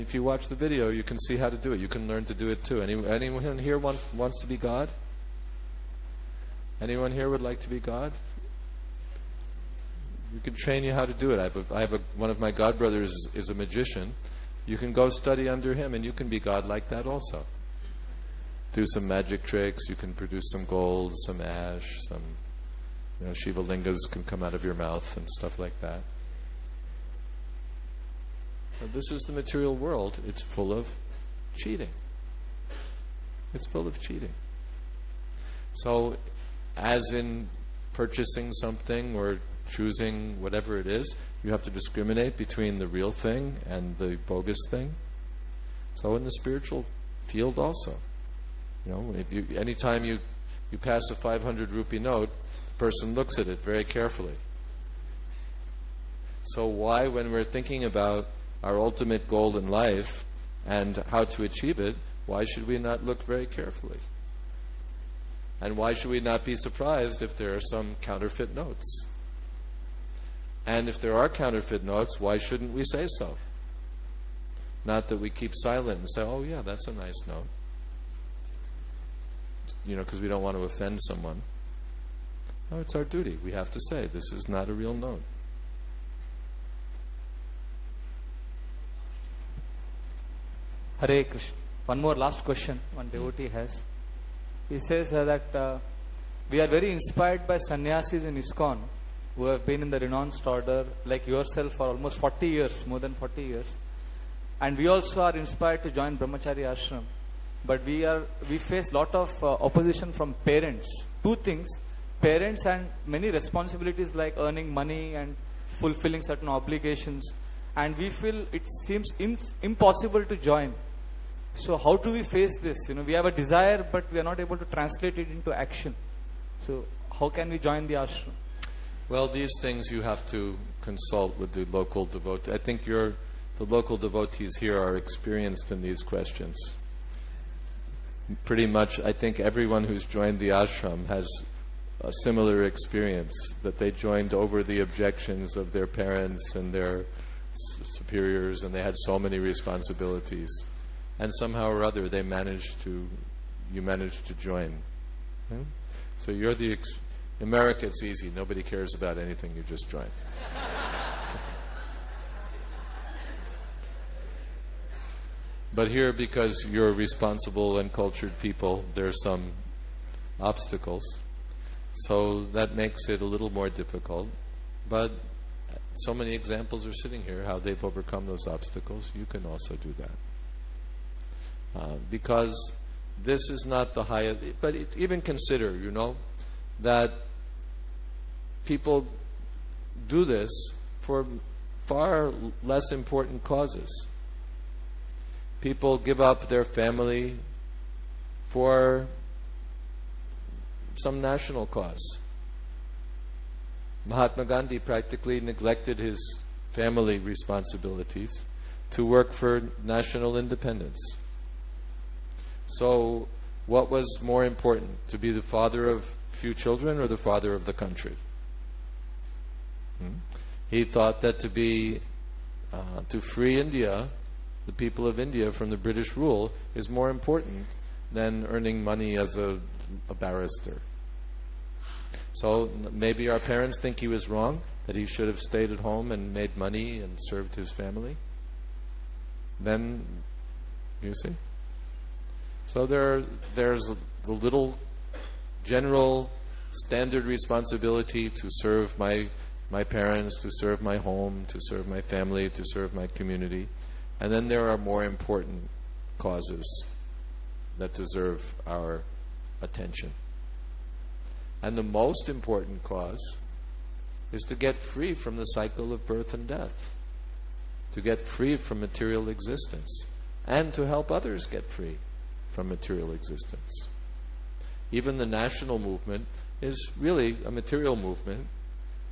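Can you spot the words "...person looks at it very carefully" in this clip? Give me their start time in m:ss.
0:52.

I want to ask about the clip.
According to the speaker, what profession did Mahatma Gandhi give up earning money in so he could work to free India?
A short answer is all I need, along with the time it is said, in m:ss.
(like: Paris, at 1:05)
barrister, at 3:50.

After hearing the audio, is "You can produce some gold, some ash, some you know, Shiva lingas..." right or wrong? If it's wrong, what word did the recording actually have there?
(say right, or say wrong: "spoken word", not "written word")
right.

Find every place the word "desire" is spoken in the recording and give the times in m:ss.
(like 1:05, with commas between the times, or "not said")
2:03.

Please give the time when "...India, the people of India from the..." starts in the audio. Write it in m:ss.
3:43.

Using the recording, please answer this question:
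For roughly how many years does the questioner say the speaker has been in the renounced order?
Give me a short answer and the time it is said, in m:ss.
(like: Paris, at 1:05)
more than 40 years, at 1:42.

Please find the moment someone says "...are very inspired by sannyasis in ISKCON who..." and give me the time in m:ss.
1:36.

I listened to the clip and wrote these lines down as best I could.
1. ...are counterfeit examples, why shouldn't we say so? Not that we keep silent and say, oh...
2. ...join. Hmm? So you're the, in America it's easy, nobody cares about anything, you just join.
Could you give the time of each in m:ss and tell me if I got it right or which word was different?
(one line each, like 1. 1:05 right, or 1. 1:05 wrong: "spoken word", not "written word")
1. 1:11 wrong: "notes", not "examples"
2. 2:34 right.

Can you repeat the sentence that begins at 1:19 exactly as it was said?
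You know, because we don't want to offend someone.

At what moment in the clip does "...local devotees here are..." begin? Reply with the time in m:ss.
2:13.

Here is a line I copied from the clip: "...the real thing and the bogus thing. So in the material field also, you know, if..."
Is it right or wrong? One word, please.
wrong.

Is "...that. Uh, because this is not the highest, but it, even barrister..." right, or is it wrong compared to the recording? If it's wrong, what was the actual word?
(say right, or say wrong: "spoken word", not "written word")
wrong: "consider", not "barrister".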